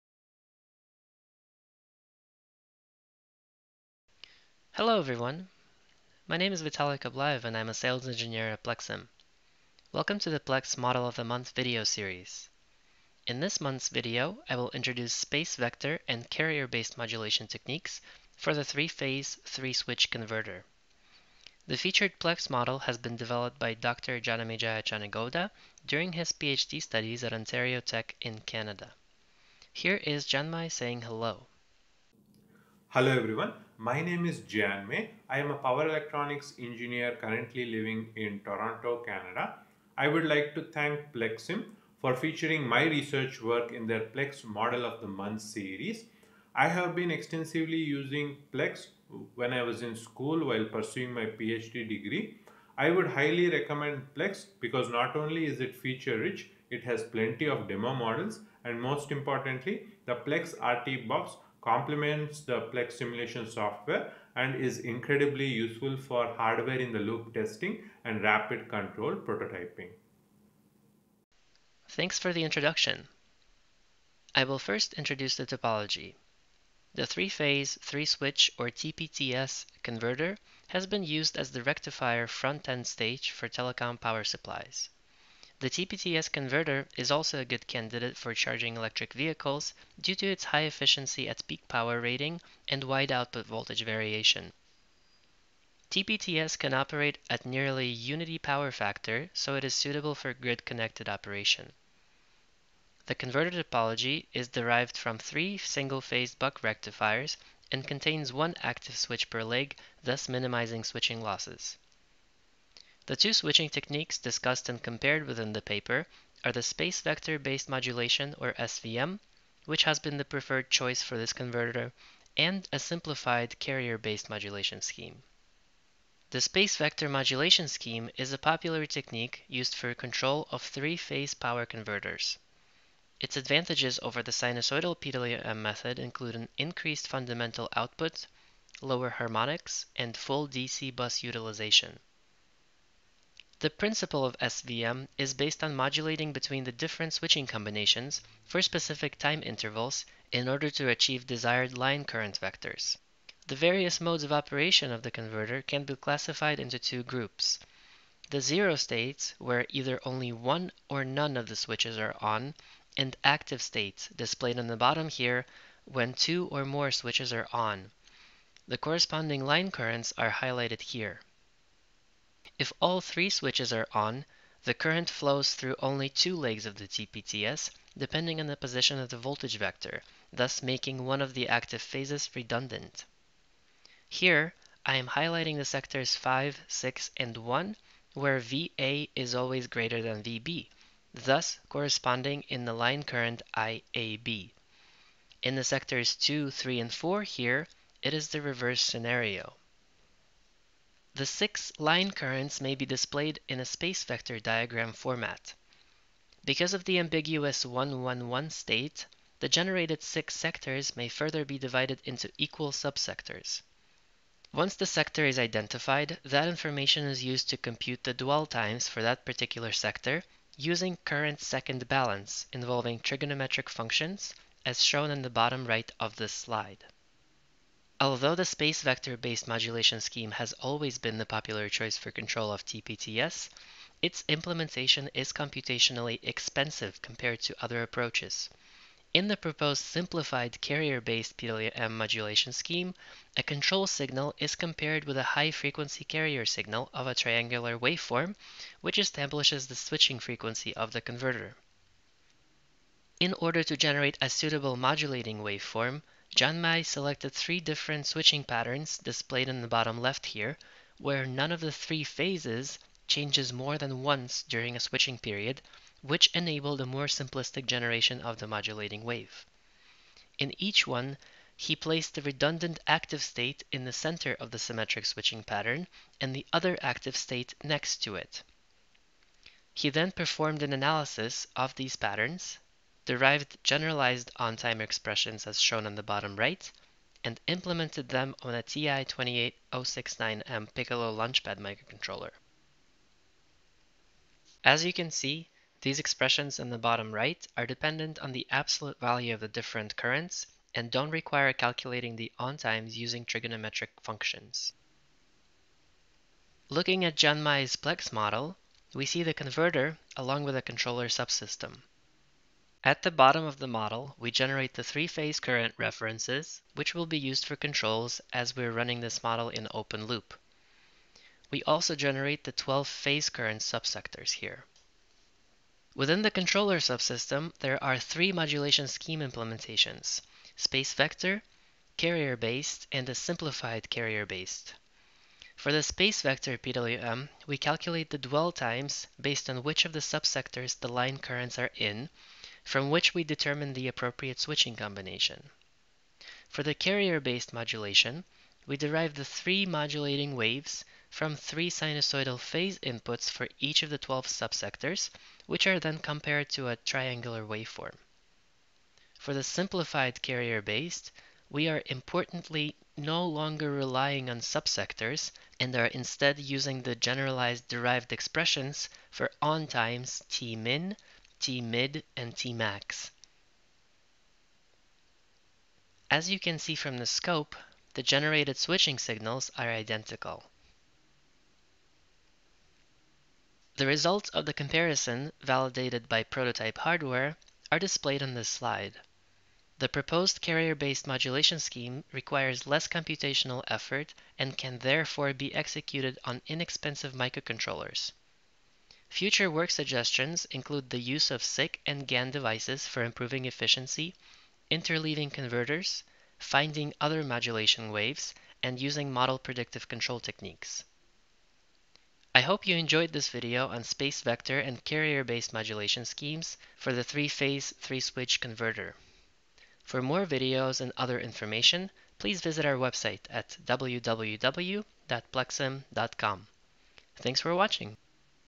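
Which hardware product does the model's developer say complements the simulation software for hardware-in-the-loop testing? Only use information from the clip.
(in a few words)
PLECS RT box.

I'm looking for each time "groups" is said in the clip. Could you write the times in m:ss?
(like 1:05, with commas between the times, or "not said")
2:37.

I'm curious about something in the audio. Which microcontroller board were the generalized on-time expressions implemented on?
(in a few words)
TI-28069M Piccolo Launchpad.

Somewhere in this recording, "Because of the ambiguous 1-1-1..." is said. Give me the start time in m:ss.
3:26.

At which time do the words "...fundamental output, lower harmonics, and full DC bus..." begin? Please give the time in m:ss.
2:17.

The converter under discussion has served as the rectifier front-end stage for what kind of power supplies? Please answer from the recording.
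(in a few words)
Telecom power supplies.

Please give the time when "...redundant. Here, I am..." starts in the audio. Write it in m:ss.
3:02.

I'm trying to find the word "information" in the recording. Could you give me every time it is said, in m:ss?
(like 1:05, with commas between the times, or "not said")
3:36, 7:01.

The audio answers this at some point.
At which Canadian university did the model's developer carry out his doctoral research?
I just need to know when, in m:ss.
0:27.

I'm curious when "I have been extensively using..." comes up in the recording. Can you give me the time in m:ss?
0:46.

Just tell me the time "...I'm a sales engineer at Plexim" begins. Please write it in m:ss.
0:07.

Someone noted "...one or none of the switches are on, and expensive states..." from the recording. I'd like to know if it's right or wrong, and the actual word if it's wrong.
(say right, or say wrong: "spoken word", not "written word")
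wrong: "active", not "expensive".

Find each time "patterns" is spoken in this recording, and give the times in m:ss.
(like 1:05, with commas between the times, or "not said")
4:18, 4:35, 4:41.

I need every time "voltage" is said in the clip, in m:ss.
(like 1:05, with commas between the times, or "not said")
1:33, 2:59.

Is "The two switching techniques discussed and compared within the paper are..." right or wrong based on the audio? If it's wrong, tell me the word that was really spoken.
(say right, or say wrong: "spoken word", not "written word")
right.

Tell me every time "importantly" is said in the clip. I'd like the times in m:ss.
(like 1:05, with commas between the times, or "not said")
0:59, 6:01.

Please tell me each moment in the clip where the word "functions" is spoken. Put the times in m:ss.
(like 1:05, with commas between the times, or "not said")
3:43, 5:04.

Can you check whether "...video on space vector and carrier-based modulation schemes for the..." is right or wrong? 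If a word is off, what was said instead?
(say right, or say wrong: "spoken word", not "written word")
right.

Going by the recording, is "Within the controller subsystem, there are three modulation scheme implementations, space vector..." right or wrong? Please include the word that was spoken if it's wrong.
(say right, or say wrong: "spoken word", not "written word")
right.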